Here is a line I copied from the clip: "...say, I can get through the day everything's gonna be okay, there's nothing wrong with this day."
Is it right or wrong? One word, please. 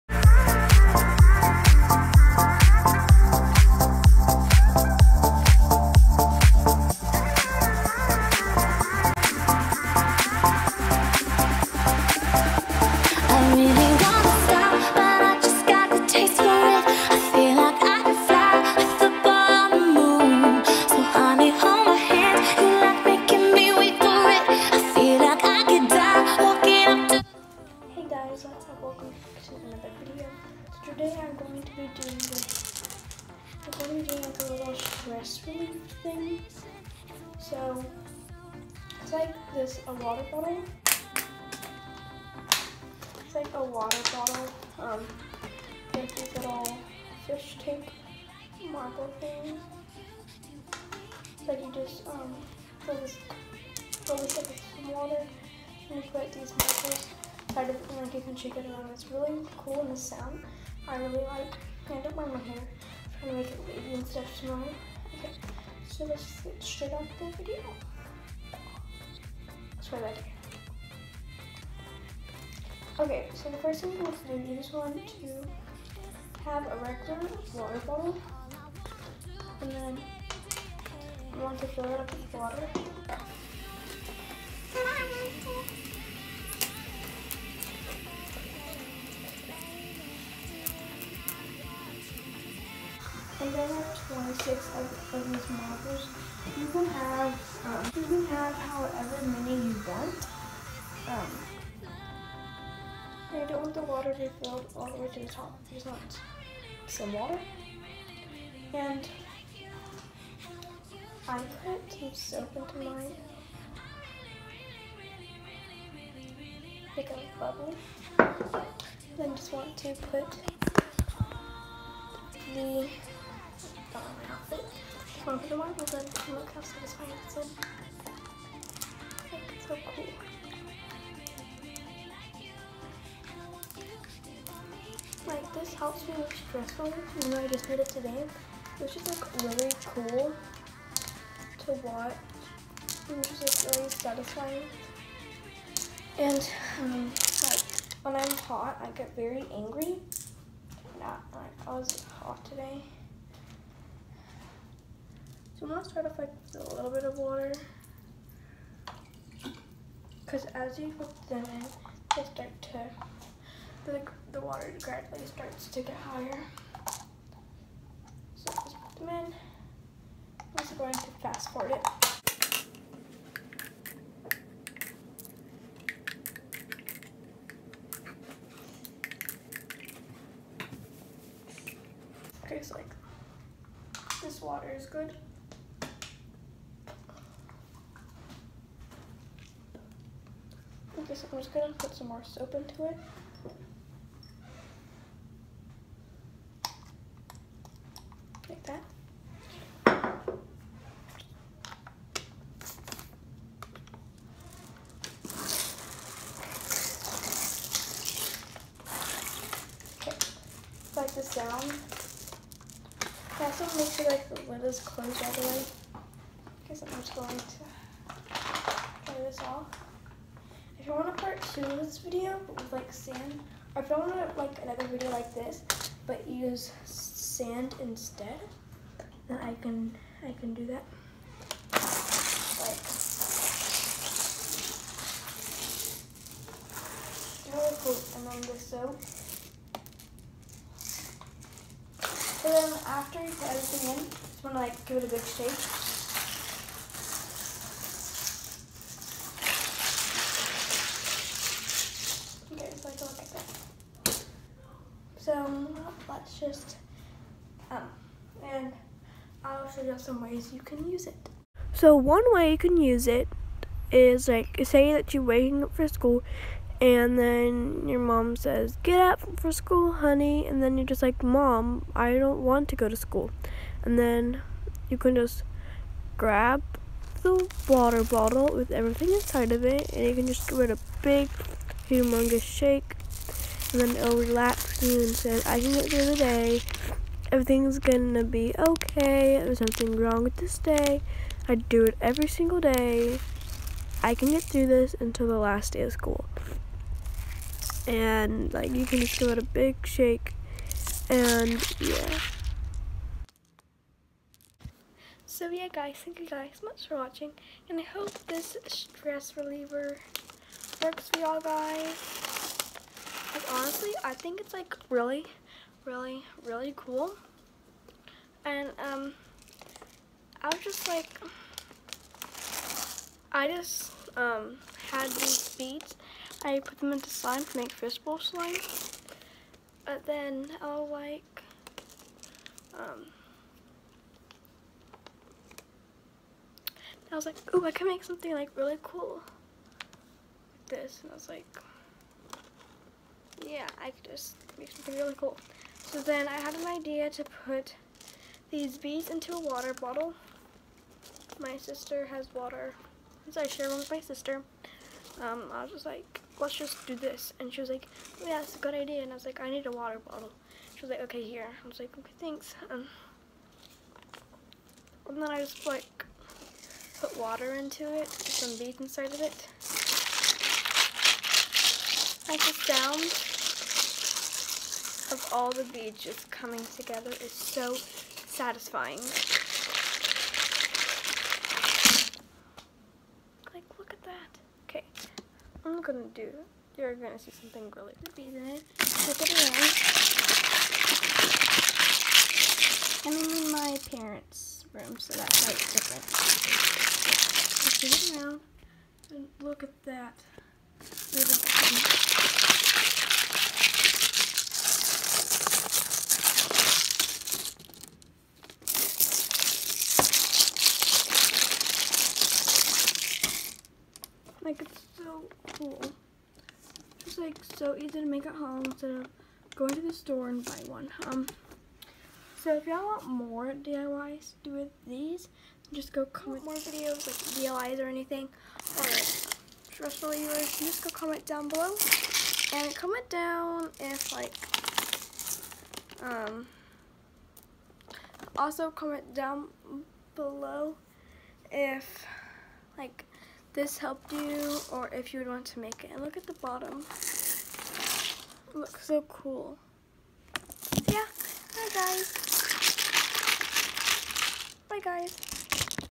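right.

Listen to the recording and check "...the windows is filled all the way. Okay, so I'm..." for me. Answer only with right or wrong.
wrong.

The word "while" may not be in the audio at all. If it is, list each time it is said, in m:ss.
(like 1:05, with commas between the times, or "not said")
2:05.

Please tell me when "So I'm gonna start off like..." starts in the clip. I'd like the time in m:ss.
2:35.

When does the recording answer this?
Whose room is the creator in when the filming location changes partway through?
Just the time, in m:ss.
6:33.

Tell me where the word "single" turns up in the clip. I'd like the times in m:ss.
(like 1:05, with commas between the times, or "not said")
4:52.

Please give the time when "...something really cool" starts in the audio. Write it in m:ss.
5:44.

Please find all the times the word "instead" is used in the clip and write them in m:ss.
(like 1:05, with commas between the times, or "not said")
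3:47, 6:58.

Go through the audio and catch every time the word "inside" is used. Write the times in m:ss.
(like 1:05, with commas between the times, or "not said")
4:39, 6:08.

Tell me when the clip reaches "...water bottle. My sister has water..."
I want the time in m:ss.
5:49.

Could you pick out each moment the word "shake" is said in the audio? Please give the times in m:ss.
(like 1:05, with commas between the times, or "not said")
0:58, 4:05, 4:42, 4:59.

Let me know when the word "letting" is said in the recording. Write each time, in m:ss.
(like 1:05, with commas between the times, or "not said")
not said.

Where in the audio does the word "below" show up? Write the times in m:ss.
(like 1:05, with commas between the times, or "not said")
7:11, 7:20.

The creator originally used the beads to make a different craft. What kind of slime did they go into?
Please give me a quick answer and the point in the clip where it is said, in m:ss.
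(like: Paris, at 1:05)
fishbowl slime, at 5:27.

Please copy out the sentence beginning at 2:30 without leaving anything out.
Yeah, like I was hot today.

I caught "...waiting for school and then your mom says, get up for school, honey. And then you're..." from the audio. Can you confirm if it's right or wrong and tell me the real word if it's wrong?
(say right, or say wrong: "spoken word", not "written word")
right.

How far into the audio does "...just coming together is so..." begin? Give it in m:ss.
6:16.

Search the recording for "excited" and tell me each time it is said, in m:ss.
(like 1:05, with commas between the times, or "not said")
0:57.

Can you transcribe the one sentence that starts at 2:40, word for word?
Because as you put them in, they start to, the, the water gradually starts to get higher.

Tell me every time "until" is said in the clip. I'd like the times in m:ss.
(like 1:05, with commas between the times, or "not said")
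4:54.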